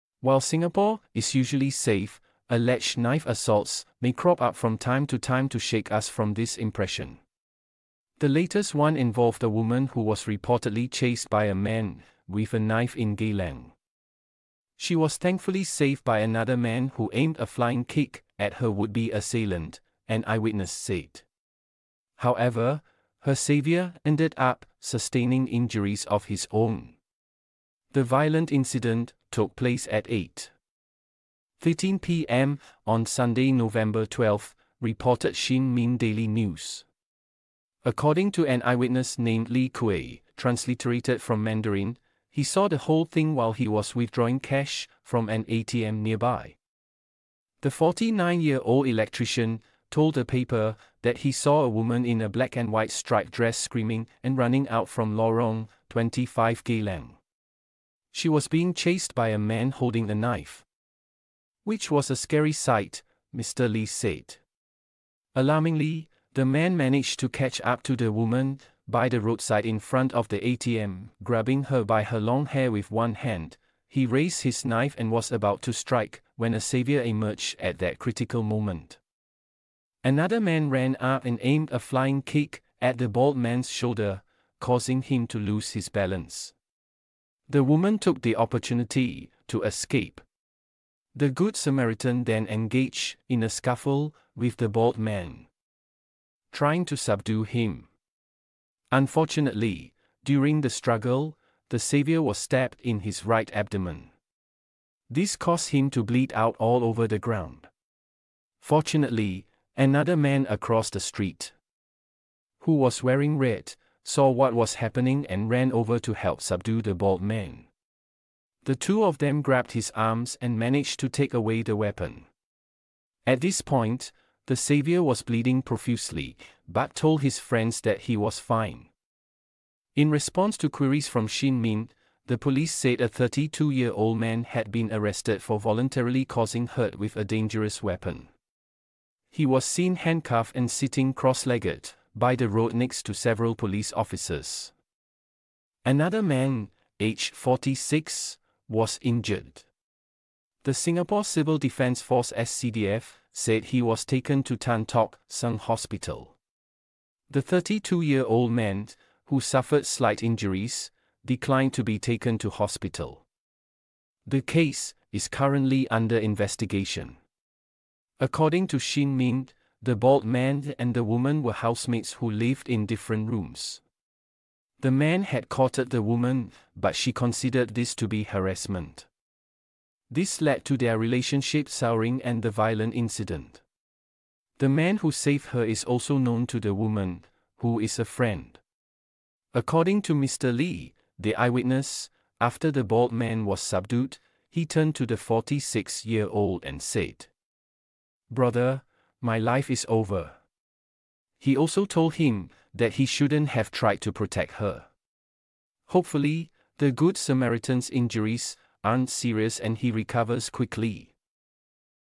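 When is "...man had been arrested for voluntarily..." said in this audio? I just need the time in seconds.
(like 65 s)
134 s.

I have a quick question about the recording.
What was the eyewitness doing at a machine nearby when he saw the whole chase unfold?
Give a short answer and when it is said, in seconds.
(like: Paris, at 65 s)
Withdrawing cash, at 43 s.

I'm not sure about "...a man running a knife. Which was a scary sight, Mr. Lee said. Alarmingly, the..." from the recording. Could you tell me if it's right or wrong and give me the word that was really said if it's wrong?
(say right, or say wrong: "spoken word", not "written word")
wrong: "holding", not "running".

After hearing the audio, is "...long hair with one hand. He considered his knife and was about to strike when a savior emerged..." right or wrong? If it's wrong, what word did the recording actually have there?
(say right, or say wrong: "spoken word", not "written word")
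wrong: "raised", not "considered".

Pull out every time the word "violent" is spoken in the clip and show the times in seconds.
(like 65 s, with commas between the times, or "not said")
28 s, 182 s.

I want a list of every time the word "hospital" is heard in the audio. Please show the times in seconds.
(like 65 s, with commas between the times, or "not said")
155 s, 162 s.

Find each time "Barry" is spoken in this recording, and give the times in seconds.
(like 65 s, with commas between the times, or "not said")
not said.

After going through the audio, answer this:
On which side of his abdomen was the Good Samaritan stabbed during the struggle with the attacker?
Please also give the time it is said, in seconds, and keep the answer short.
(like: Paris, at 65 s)
Right, at 103 s.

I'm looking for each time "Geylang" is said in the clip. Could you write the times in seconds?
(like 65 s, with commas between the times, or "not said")
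13 s, 56 s.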